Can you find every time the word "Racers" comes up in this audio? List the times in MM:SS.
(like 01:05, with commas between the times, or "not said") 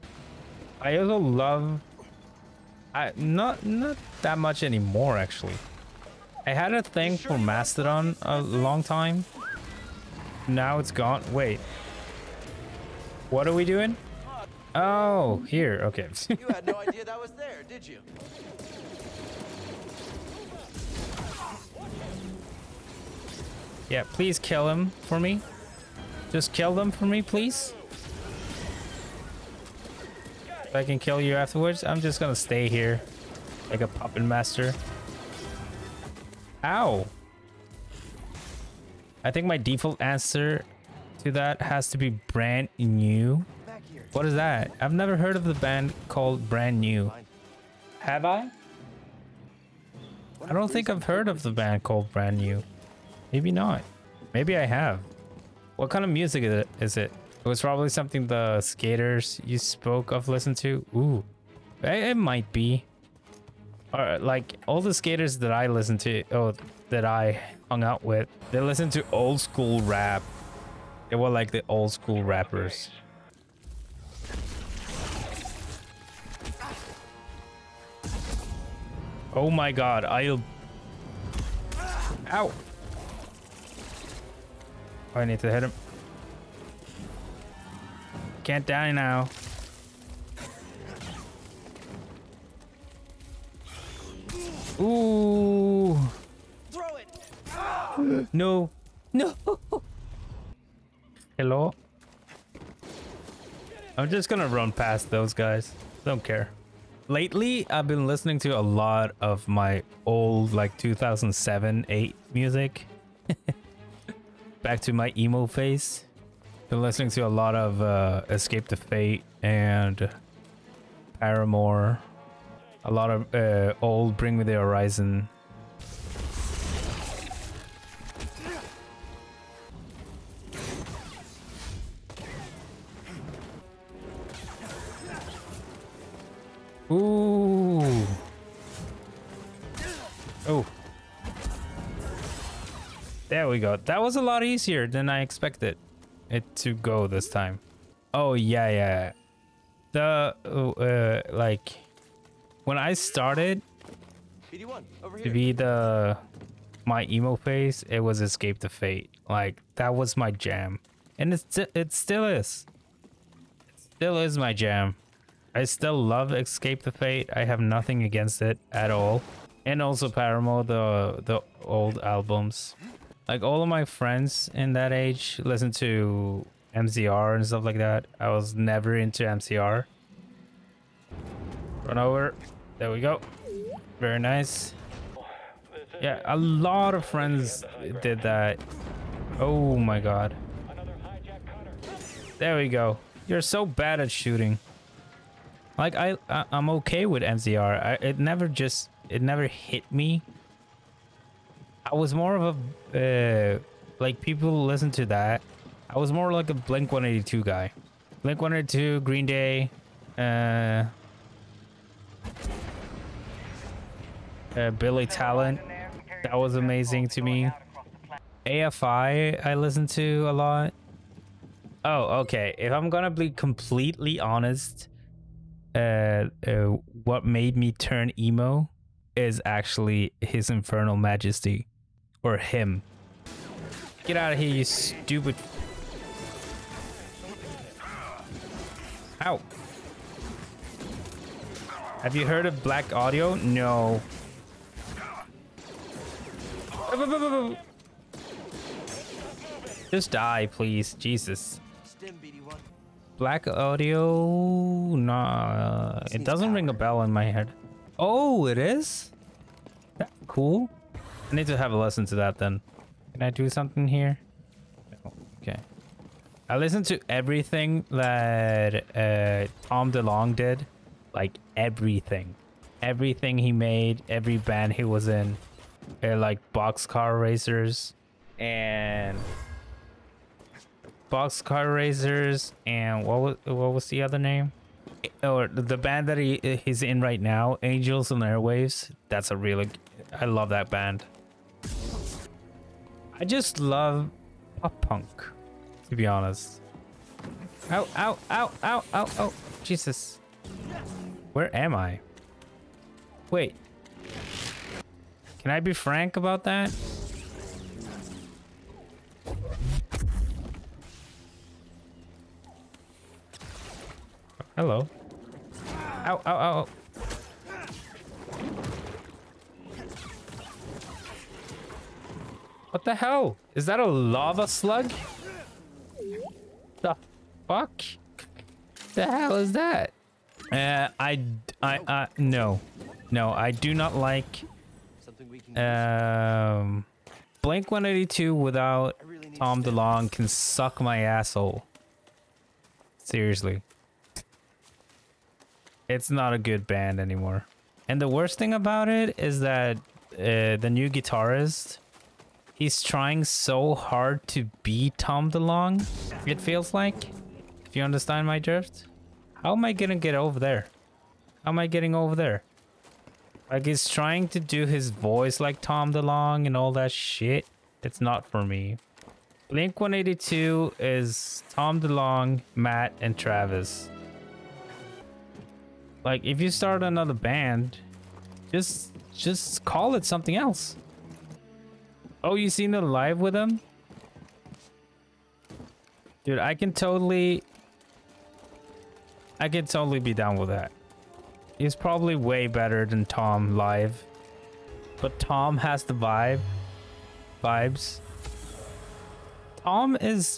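04:37, 04:41.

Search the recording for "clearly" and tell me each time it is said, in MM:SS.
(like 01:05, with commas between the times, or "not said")
not said.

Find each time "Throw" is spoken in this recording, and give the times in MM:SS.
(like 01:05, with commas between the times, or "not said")
01:36.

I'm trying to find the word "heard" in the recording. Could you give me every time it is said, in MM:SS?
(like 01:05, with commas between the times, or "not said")
00:45, 00:51, 04:02.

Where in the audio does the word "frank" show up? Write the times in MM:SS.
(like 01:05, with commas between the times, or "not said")
05:05.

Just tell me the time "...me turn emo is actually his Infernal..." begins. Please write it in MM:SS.
03:47.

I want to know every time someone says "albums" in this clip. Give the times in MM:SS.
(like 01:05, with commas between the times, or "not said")
02:51.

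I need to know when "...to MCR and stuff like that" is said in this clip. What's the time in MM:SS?
02:55.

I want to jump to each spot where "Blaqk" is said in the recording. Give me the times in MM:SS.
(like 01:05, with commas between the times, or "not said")
04:02, 04:13.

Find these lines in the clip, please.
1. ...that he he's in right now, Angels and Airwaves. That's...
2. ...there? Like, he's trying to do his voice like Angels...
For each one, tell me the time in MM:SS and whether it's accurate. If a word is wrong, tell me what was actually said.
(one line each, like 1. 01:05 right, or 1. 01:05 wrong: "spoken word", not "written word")
1. 04:46 right
2. 06:02 wrong: "Tom", not "Angels".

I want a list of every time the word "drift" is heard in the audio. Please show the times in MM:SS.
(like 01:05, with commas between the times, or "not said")
05:58.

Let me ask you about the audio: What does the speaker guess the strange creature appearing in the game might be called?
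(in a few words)
lava slug.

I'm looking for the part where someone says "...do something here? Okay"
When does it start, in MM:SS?
04:23.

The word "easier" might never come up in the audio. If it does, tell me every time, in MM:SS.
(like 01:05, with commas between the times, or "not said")
02:24.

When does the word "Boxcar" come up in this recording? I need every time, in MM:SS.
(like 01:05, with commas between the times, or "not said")
04:36, 04:41.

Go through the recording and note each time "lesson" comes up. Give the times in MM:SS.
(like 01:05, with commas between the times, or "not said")
04:21.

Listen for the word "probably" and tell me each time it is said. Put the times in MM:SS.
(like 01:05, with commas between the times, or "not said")
00:57, 06:31.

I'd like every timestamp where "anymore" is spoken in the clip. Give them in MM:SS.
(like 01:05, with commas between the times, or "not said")
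00:04, 05:47.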